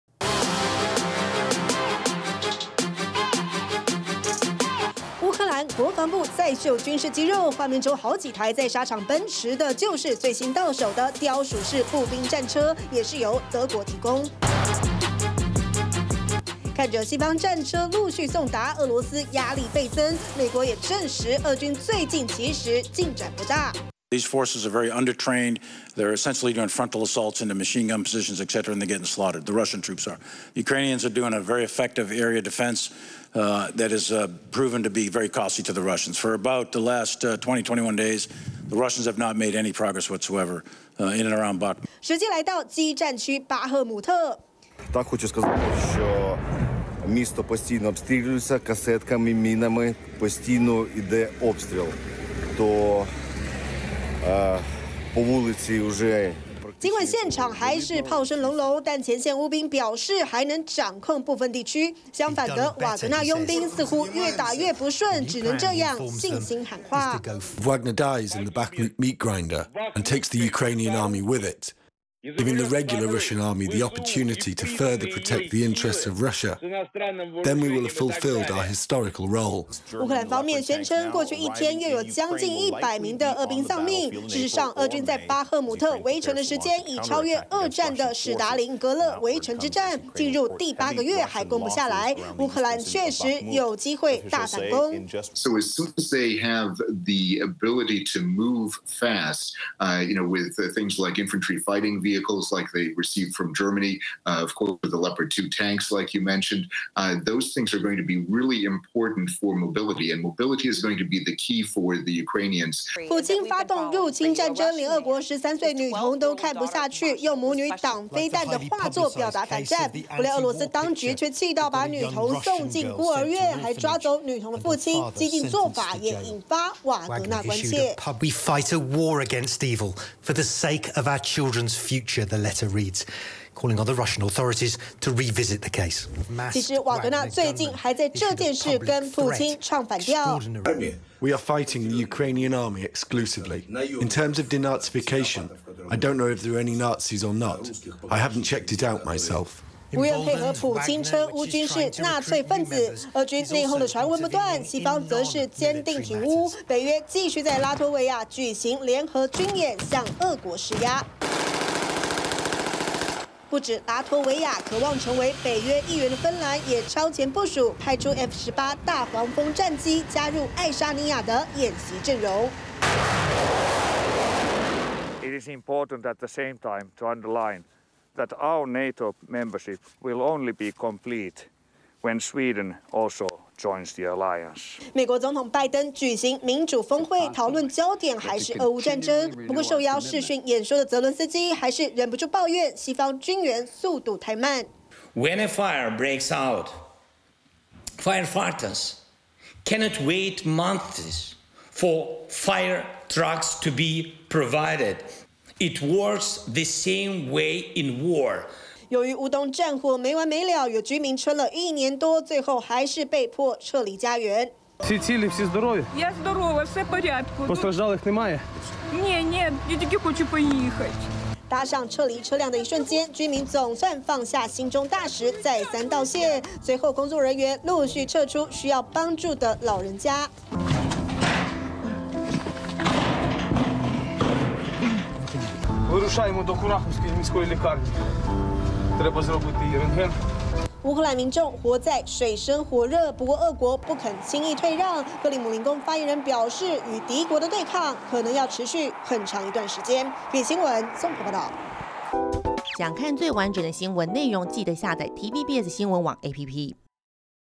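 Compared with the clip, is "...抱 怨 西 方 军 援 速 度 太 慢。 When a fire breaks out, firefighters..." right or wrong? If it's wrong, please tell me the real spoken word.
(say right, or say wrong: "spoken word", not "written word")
right.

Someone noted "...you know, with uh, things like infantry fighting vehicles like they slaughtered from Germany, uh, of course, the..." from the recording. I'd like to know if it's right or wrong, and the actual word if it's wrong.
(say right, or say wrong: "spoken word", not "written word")
wrong: "received", not "slaughtered".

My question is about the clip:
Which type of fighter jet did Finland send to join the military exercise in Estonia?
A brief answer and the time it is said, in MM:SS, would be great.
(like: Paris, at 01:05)
F-18 Hornet, at 02:48.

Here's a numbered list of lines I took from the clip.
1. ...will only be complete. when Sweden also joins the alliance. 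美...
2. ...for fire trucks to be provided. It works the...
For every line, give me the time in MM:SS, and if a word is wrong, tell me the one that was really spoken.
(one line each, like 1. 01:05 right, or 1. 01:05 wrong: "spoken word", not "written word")
1. 03:00 right
2. 03:21 right.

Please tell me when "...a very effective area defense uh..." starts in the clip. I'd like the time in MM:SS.
00:31.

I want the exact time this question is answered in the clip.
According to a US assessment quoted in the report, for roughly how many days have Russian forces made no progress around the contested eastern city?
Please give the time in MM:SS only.
00:37.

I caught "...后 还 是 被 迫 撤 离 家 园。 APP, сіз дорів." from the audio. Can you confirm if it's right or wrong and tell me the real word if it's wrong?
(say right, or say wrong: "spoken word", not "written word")
wrong: "Сітили", not "APP".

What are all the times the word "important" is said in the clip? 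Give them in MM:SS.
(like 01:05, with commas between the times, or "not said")
01:48, 02:55.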